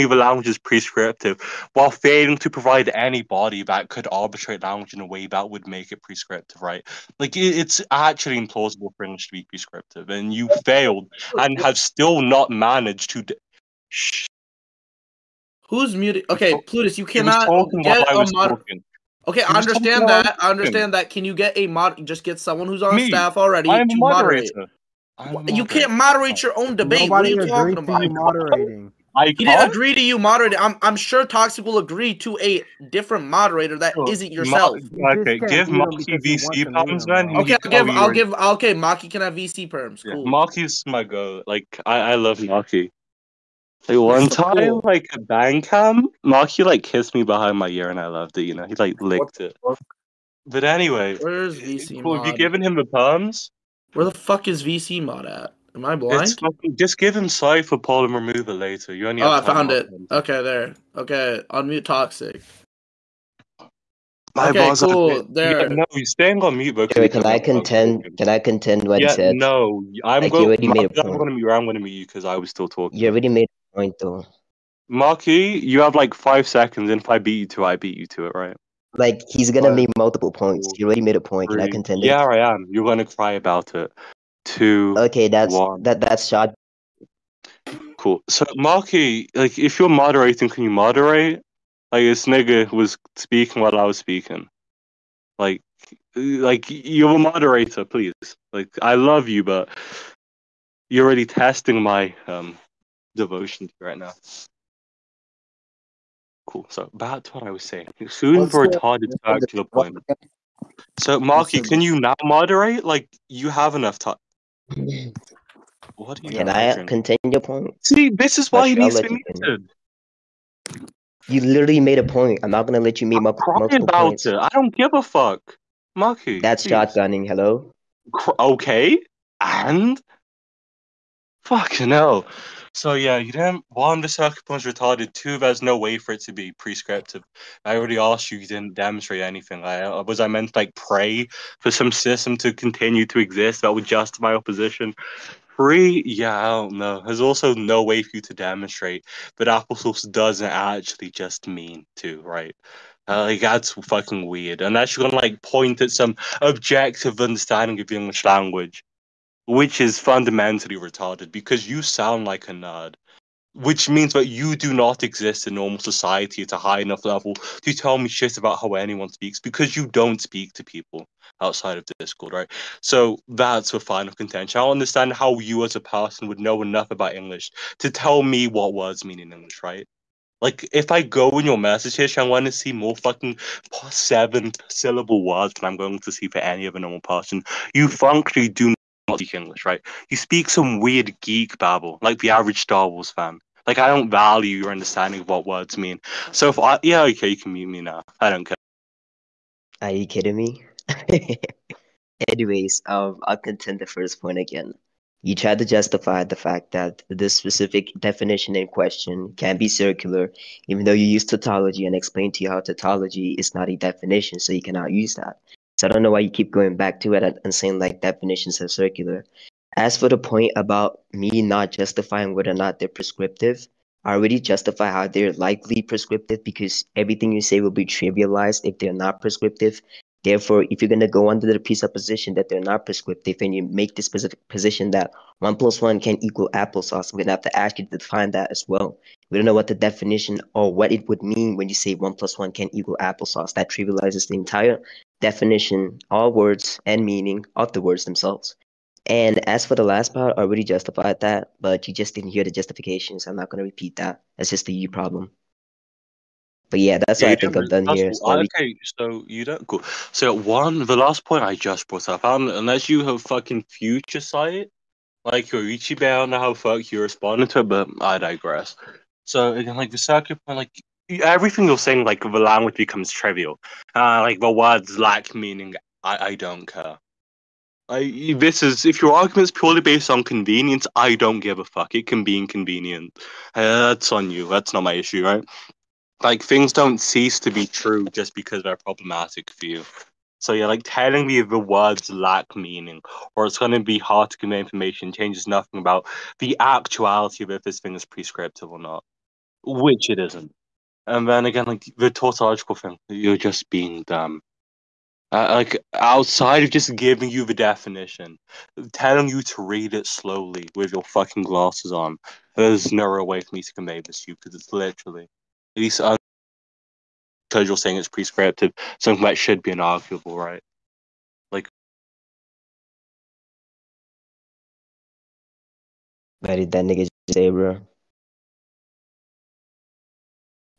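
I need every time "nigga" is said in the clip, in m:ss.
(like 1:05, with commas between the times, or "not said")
1:32, 5:26.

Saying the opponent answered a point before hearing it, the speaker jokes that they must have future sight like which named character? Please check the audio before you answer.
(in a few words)
Ichiban.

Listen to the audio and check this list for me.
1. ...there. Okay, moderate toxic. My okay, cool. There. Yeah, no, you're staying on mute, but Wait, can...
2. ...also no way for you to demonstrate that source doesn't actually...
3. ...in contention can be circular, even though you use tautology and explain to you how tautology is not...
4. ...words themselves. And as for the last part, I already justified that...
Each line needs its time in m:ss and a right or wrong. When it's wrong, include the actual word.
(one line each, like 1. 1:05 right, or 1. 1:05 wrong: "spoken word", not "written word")
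1. 1:00 wrong: "unmute", not "moderate"
2. 2:27 right
3. 3:28 wrong: "question", not "contention"
4. 4:07 right.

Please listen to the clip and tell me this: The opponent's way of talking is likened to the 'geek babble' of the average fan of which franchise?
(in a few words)
Star Wars.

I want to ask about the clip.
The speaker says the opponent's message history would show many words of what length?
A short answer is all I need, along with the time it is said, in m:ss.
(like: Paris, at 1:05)
7 syllable, at 3:03.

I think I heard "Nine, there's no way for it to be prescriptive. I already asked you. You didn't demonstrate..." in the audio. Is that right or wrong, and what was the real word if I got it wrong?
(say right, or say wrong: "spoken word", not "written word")
wrong: "Two", not "Nine".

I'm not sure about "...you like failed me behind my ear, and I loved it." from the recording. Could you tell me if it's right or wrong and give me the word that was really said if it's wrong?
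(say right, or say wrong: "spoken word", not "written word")
wrong: "kissed", not "failed".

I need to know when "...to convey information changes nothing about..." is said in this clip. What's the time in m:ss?
4:54.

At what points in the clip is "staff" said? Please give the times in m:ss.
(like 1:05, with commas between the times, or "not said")
0:23.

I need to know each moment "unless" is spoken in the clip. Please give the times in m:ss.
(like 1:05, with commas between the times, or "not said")
2:34, 4:22.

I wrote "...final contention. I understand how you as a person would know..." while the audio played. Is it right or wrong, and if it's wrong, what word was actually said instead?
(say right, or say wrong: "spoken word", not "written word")
right.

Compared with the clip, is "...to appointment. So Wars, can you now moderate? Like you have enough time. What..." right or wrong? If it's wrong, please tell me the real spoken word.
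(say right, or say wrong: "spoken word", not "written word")
wrong: "Marky", not "Wars".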